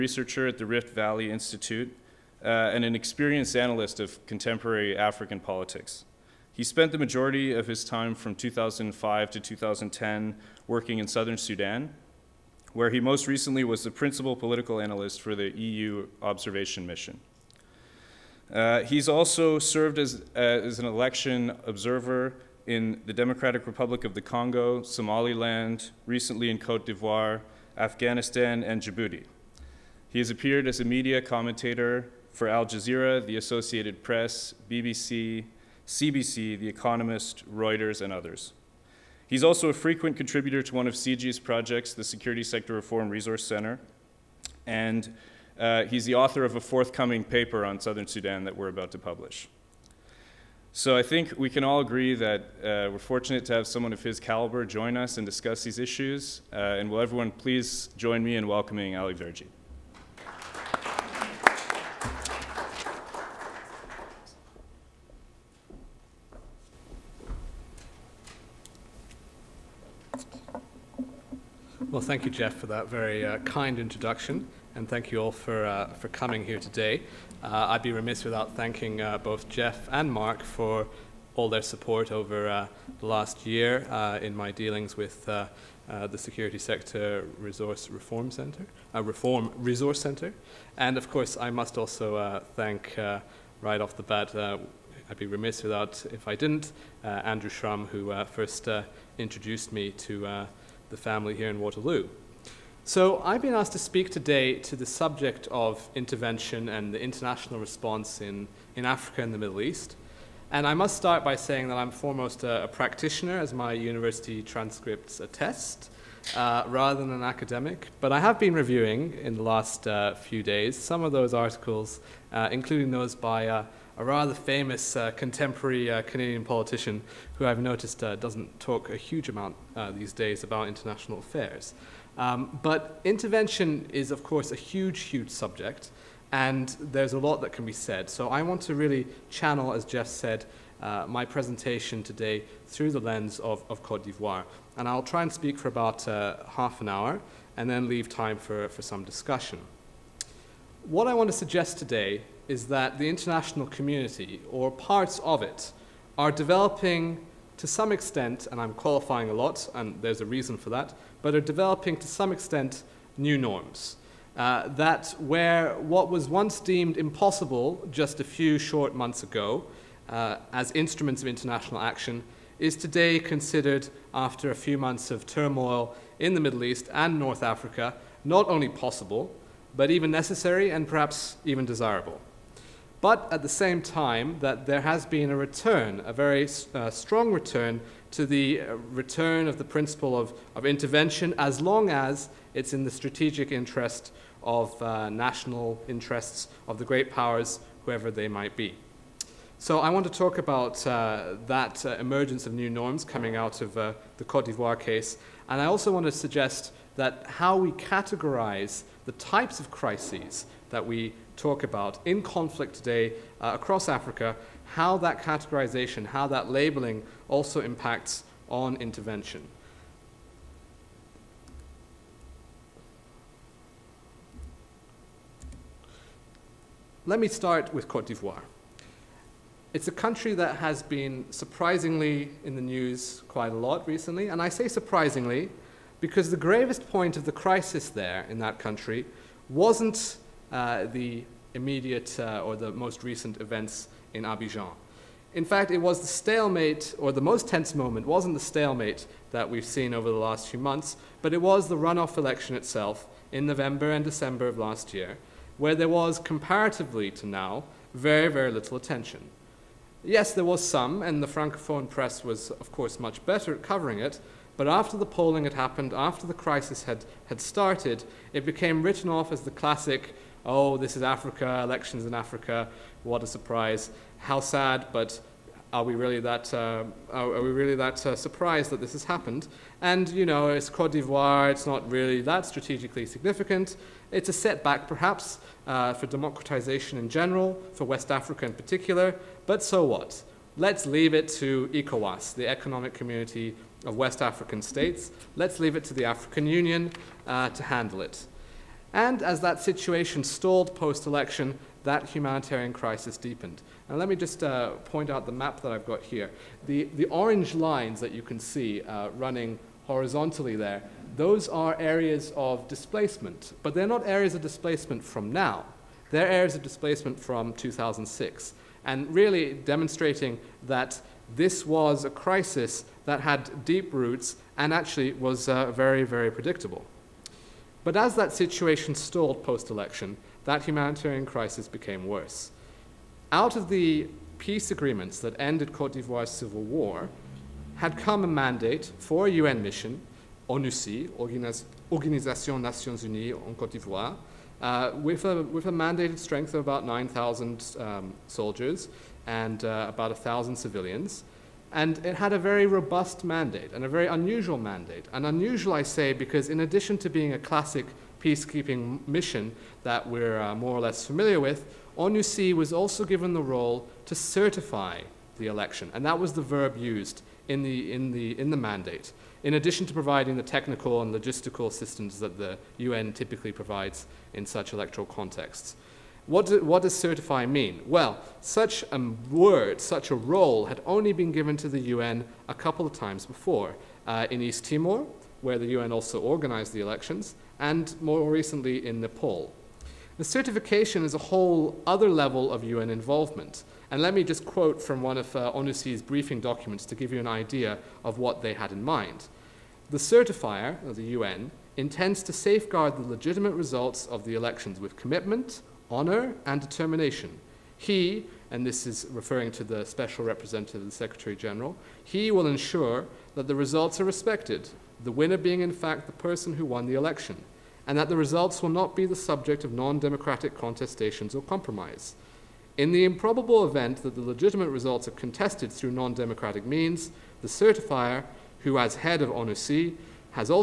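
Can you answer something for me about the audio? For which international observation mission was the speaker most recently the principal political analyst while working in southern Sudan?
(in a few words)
EU observation mission.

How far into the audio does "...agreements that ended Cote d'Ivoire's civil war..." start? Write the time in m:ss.
5:34.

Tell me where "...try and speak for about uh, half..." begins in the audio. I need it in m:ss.
2:25.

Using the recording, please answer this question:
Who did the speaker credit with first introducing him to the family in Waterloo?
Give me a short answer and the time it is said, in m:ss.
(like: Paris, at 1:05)
Andrew Schramm, at 1:37.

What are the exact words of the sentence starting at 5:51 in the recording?
And it had a very robust mandate and a very unusual mandate.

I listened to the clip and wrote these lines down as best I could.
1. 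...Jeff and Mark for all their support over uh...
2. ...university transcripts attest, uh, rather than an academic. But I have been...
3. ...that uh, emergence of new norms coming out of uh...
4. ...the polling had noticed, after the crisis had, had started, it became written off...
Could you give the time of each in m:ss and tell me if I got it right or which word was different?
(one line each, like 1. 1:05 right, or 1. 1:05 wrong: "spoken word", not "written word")
1. 1:19 right
2. 1:53 right
3. 3:21 right
4. 4:24 wrong: "happened", not "noticed".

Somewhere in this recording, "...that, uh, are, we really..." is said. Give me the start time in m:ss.
4:36.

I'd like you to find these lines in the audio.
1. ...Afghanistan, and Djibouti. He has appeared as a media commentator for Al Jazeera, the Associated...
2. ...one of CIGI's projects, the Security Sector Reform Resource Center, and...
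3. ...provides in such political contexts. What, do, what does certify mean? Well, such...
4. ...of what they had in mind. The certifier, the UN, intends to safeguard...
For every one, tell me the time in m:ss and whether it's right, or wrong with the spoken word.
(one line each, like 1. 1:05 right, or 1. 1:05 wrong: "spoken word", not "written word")
1. 0:27 right
2. 0:40 right
3. 6:13 wrong: "electoral", not "political"
4. 6:38 right.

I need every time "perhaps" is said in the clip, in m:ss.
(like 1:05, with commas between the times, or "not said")
3:00, 4:44.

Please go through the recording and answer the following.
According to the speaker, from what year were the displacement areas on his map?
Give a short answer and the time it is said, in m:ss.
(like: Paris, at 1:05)
2006, at 5:17.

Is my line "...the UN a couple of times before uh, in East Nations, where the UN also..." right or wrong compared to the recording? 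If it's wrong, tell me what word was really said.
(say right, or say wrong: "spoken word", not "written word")
wrong: "Timor", not "Nations".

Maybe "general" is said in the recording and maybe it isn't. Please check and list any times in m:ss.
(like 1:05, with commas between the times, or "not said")
4:47, 6:51.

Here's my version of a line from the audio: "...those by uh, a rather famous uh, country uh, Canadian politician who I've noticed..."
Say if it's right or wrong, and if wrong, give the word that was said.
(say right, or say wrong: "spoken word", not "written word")
wrong: "contemporary", not "country".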